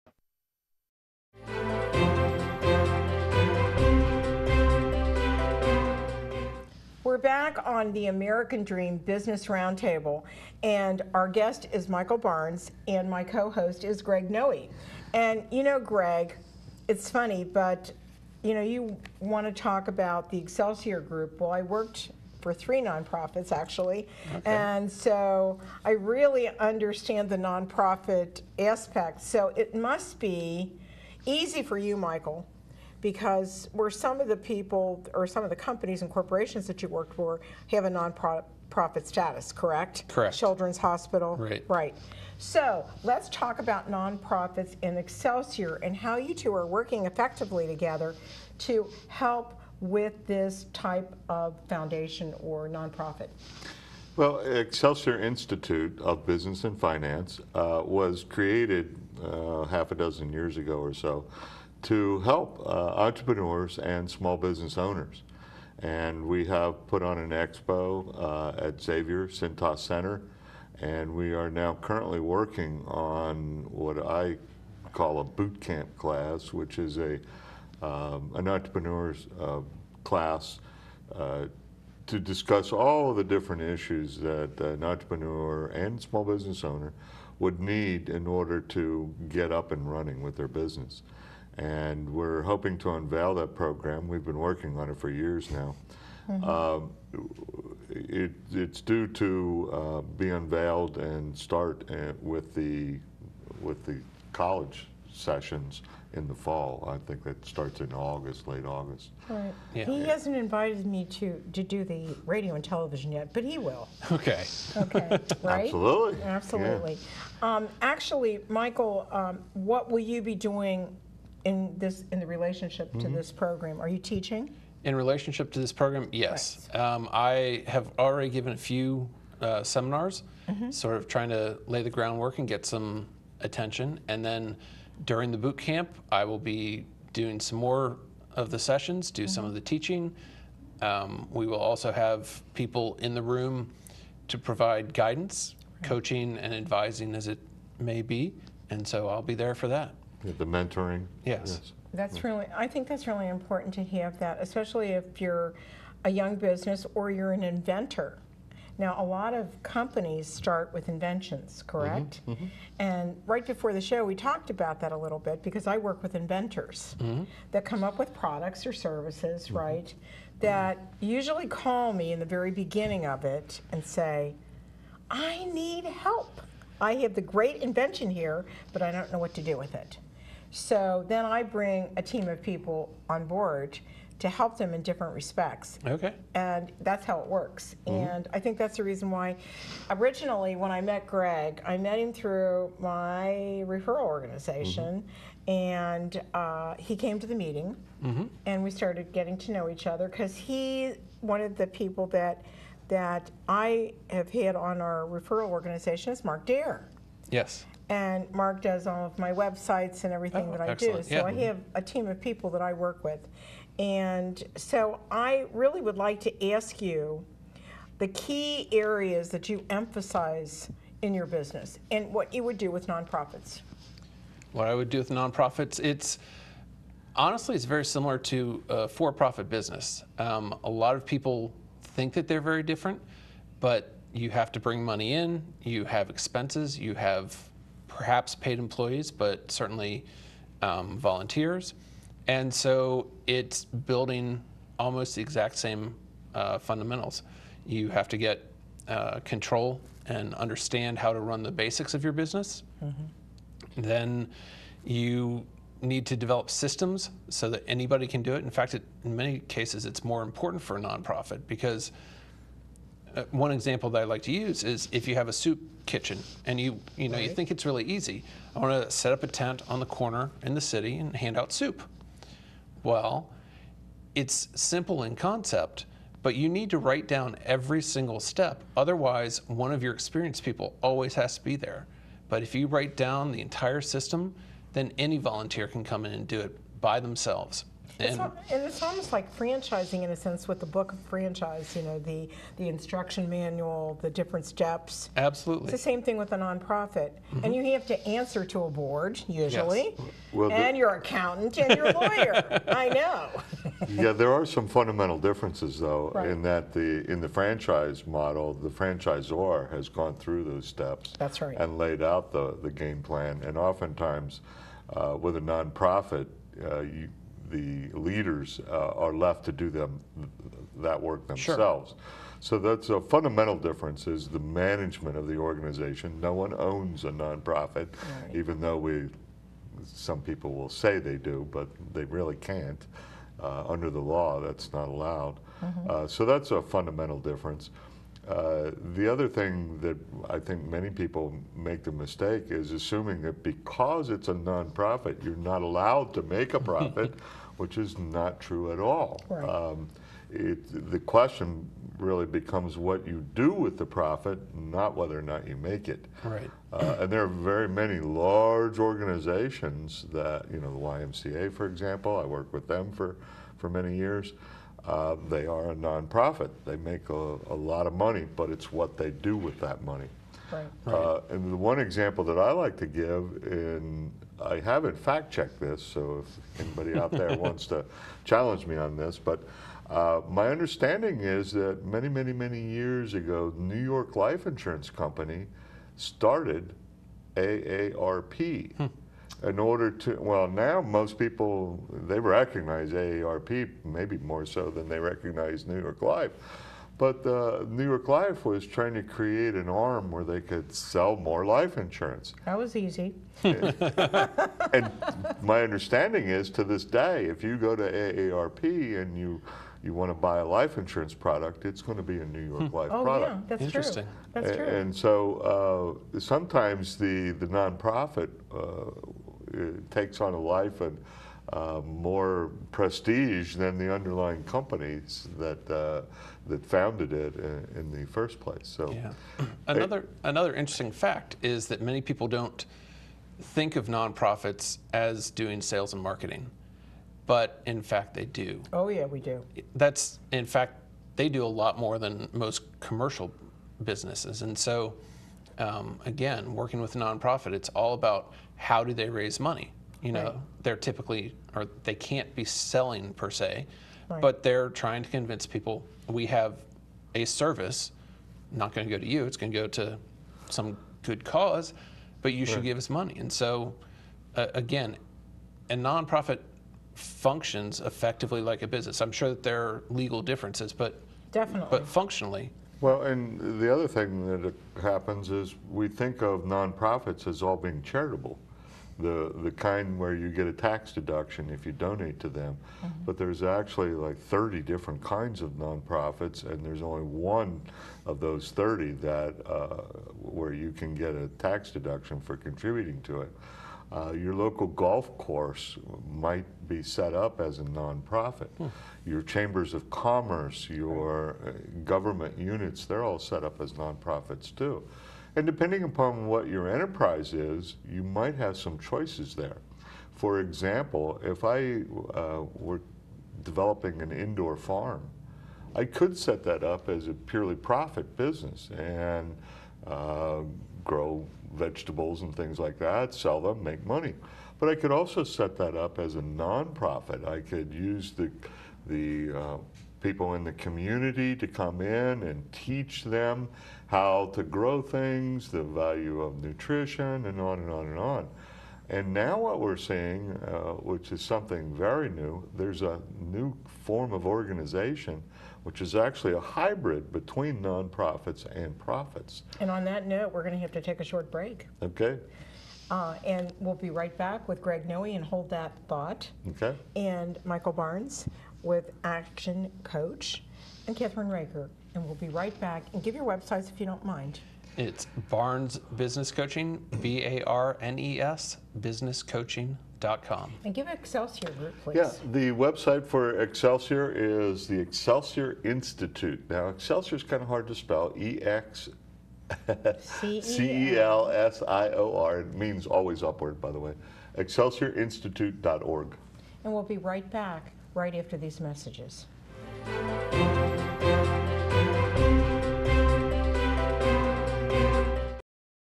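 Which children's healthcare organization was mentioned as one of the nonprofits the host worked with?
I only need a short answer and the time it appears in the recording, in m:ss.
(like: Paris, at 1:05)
Children's Hospital, at 0:40.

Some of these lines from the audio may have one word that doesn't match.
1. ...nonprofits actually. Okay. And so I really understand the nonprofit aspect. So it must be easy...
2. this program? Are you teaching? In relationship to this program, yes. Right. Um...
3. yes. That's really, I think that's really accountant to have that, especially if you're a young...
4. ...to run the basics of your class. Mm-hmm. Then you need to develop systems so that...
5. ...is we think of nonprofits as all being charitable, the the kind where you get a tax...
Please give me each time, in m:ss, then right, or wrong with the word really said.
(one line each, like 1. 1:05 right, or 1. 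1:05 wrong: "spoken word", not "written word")
1. 0:22 right
2. 2:03 right
3. 2:31 wrong: "important", not "accountant"
4. 4:11 wrong: "business", not "class"
5. 7:55 right.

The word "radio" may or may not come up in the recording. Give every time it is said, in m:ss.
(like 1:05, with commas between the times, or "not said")
1:52.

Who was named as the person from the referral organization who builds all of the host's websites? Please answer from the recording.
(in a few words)
Mark Dare.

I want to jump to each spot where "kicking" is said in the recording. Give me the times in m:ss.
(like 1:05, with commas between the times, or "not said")
not said.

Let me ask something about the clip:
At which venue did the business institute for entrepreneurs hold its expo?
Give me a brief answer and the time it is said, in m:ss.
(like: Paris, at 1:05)
Xavier Cintas Center, at 1:08.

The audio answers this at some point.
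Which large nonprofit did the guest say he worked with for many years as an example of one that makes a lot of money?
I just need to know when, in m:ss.
6:00.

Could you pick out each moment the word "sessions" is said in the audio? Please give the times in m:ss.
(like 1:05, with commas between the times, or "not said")
1:45, 2:18.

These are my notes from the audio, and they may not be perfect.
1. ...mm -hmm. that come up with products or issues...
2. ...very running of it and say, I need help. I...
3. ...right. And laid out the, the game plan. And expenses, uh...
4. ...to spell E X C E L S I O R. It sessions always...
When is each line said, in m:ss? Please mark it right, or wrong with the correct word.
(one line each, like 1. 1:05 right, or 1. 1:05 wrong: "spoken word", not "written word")
1. 2:46 wrong: "services", not "issues"
2. 2:52 wrong: "beginning", not "running"
3. 5:11 wrong: "oftentimes", not "expenses"
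4. 9:37 wrong: "means", not "sessions".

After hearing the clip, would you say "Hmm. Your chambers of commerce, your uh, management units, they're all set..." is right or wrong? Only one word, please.
wrong.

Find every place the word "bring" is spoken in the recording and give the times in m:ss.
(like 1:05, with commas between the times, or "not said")
3:01, 3:54.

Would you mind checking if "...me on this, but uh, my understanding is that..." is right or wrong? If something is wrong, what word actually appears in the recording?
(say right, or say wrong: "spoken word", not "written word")
right.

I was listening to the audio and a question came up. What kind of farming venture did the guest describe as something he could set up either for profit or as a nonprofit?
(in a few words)
indoor farm.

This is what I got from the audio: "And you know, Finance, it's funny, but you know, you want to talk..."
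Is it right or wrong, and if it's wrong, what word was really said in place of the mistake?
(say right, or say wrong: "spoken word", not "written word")
wrong: "Greg", not "Finance".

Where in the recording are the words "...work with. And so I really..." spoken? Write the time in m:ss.
3:32.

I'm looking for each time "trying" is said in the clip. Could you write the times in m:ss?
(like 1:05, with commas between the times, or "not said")
2:11, 6:38, 7:34.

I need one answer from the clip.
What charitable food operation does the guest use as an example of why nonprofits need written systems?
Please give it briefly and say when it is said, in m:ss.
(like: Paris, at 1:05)
soup kitchen, at 4:25.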